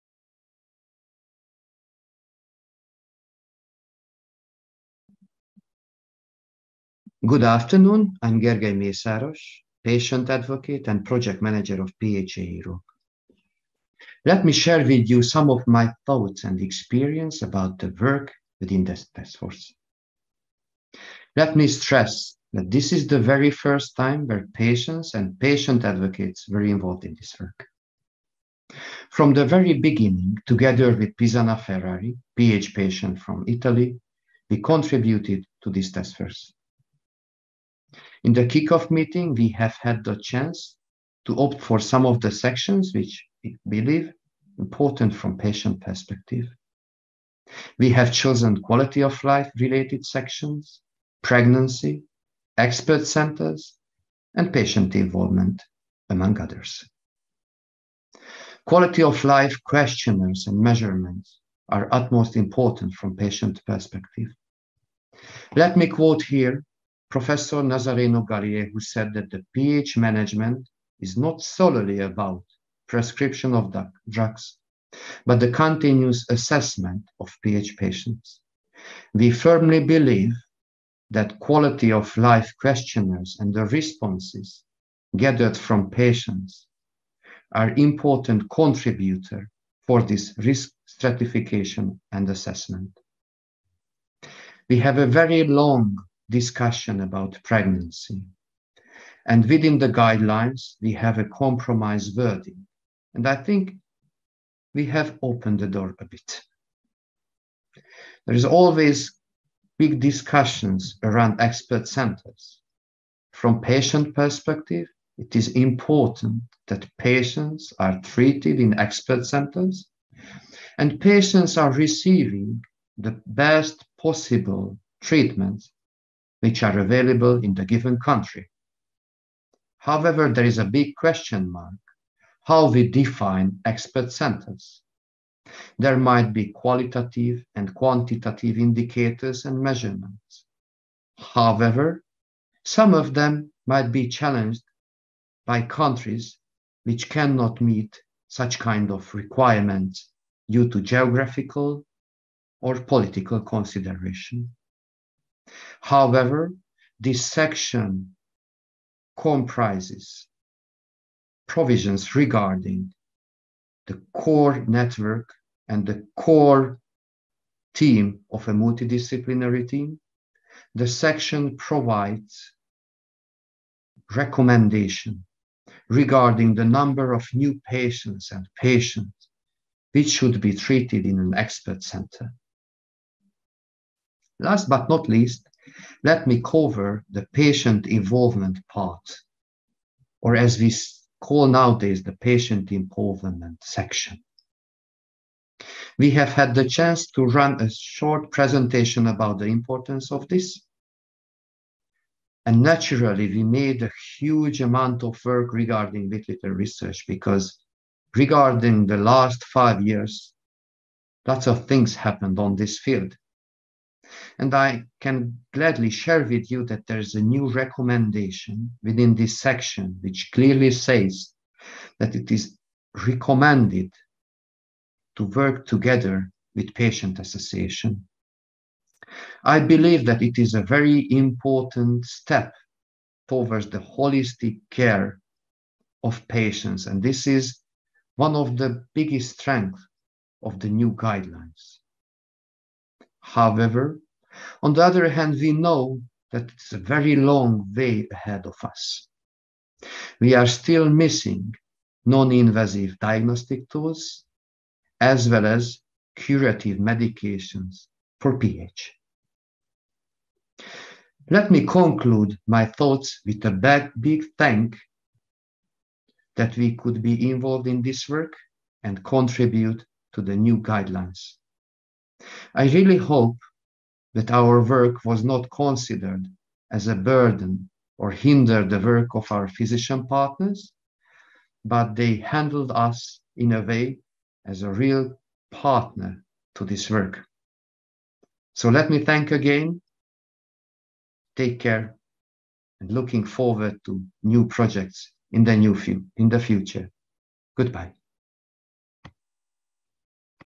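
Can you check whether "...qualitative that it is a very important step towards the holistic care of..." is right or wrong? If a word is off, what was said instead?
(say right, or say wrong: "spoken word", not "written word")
wrong: "believe", not "qualitative".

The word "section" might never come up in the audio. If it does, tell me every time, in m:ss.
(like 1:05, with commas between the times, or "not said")
0:42, 0:50, 2:37, 2:50, 3:13, 3:39.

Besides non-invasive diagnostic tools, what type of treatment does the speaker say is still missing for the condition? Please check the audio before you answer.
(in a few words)
curative medications.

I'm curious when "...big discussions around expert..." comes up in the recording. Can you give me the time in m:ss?
1:49.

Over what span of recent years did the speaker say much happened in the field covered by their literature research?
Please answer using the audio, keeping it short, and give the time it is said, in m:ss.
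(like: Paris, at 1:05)
5 years, at 3:29.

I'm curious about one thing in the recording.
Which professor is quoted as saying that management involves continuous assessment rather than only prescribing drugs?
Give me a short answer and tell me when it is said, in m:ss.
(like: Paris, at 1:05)
Nazzareno Galiè, at 1:07.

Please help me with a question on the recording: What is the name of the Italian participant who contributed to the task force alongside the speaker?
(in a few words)
Pisana Ferrari.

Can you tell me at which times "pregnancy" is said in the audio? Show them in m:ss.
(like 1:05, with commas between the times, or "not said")
0:51, 1:37.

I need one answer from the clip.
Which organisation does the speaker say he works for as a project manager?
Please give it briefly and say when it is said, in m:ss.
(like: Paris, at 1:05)
PHA Europe, at 0:12.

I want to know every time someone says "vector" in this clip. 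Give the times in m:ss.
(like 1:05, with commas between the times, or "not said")
not said.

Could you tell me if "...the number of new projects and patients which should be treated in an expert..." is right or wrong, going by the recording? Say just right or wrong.
wrong.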